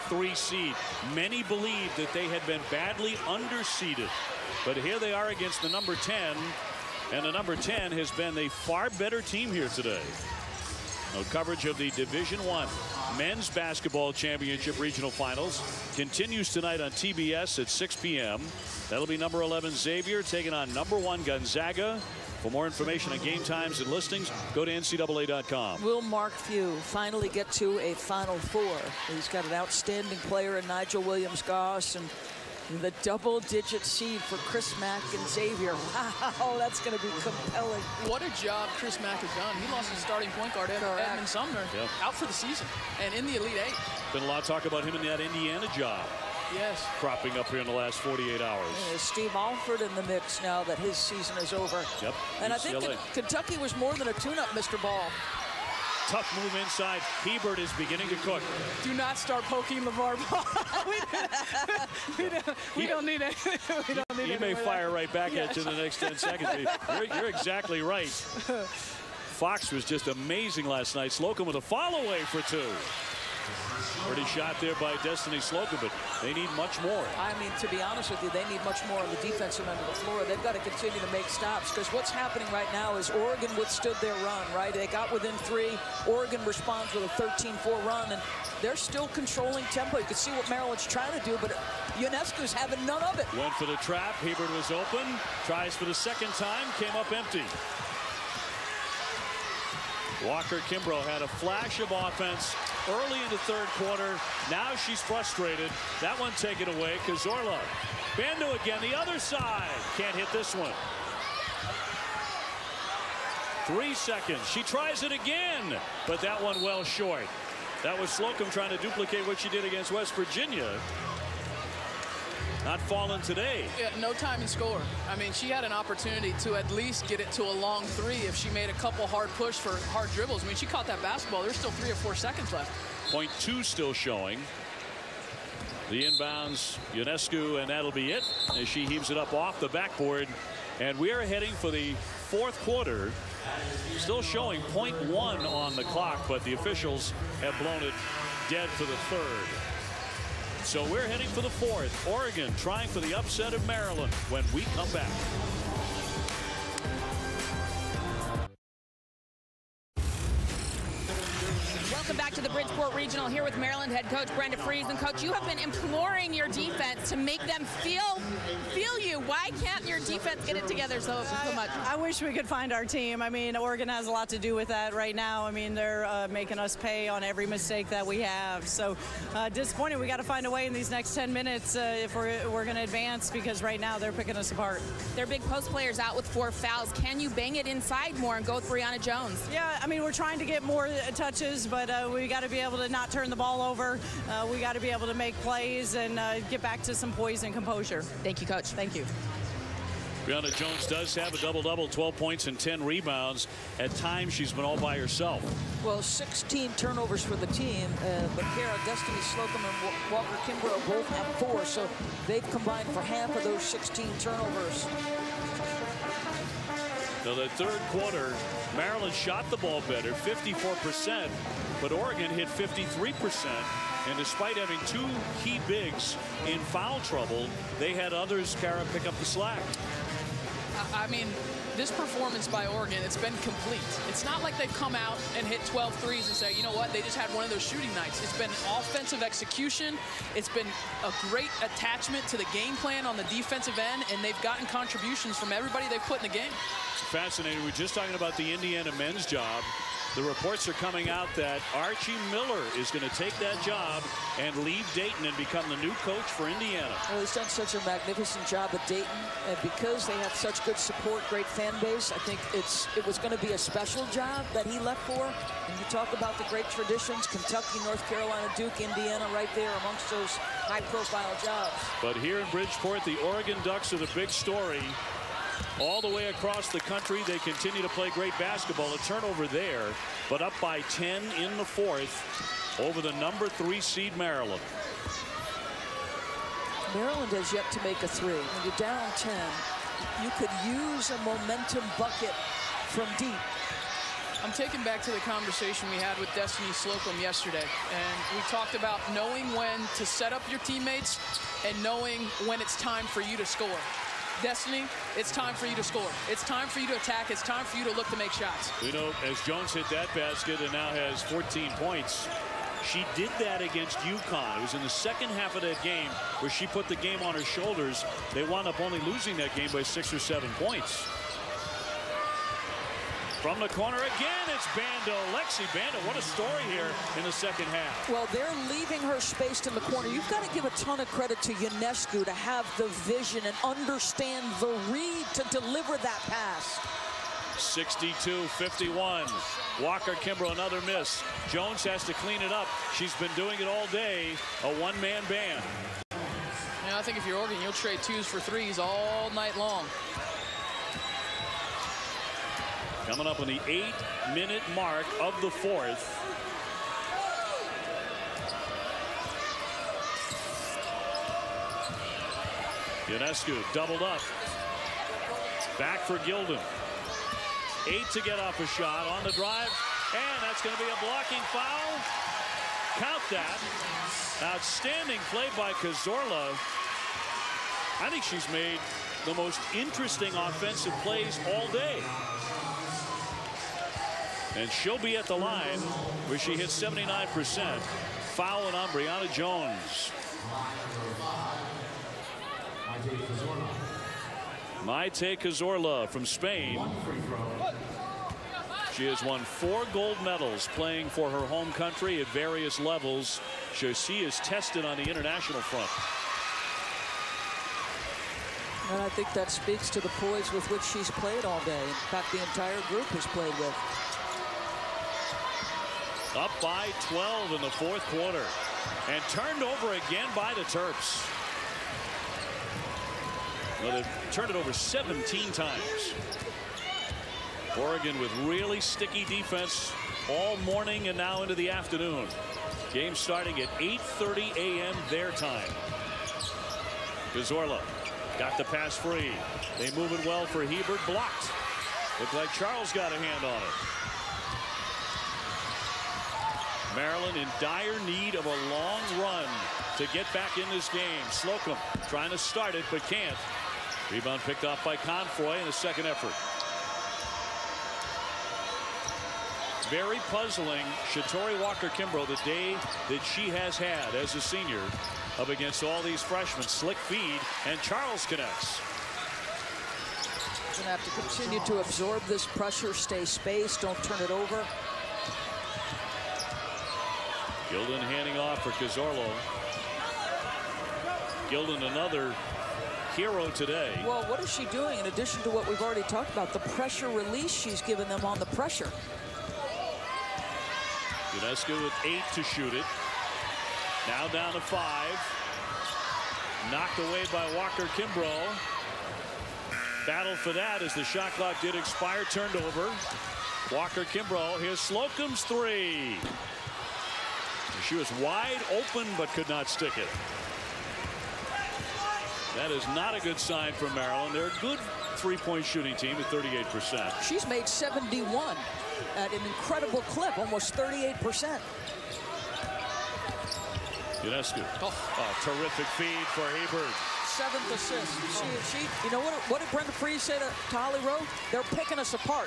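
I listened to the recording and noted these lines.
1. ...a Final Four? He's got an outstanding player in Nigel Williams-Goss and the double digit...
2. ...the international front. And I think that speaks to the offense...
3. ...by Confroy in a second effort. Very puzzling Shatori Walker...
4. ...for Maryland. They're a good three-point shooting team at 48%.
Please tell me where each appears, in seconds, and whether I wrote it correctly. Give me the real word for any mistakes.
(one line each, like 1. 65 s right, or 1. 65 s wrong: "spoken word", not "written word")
1. 27 s right
2. 404 s wrong: "poise", not "offense"
3. 454 s right
4. 513 s wrong: "38", not "48".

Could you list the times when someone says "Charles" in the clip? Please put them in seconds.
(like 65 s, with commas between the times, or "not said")
442 s, 467 s.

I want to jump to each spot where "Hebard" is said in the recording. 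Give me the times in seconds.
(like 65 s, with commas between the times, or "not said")
56 s, 94 s, 440 s, 526 s.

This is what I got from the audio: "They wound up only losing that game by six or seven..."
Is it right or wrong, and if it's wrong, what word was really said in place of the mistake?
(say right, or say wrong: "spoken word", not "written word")
right.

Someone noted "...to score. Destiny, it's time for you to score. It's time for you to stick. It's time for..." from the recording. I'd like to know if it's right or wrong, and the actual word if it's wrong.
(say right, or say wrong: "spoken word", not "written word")
wrong: "attack", not "stick".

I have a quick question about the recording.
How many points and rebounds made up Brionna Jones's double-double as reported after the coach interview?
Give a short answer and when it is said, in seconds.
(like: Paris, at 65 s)
12 points, 10 rebounds, at 201 s.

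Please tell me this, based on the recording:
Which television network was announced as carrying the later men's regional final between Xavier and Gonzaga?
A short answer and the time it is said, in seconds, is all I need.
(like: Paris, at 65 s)
TBS, at 16 s.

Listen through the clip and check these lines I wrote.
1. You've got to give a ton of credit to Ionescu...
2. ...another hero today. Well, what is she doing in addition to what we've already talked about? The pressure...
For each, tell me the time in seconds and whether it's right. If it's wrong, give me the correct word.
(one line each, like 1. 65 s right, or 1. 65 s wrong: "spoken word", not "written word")
1. 330 s right
2. 481 s right.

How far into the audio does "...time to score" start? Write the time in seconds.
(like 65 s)
124 s.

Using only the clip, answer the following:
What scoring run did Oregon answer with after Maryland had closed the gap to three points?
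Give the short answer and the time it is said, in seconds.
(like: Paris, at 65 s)
13-4, at 87 s.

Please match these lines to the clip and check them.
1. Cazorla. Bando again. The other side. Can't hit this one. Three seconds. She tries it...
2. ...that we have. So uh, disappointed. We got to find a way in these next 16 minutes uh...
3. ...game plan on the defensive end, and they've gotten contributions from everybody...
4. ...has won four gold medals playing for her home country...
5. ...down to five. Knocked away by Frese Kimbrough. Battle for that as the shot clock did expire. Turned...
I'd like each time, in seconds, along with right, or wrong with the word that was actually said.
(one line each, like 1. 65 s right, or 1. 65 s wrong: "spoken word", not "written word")
1. 107 s right
2. 177 s wrong: "10", not "16"
3. 242 s right
4. 399 s right
5. 494 s wrong: "Walker", not "Frese".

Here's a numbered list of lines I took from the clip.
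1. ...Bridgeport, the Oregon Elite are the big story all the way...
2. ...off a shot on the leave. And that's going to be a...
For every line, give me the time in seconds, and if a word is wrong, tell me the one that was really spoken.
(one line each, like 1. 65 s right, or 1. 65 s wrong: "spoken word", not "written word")
1. 272 s wrong: "Ducks", not "Elite"
2. 368 s wrong: "drive", not "leave".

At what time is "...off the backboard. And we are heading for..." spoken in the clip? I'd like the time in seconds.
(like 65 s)
139 s.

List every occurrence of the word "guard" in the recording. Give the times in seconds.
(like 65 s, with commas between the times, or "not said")
40 s.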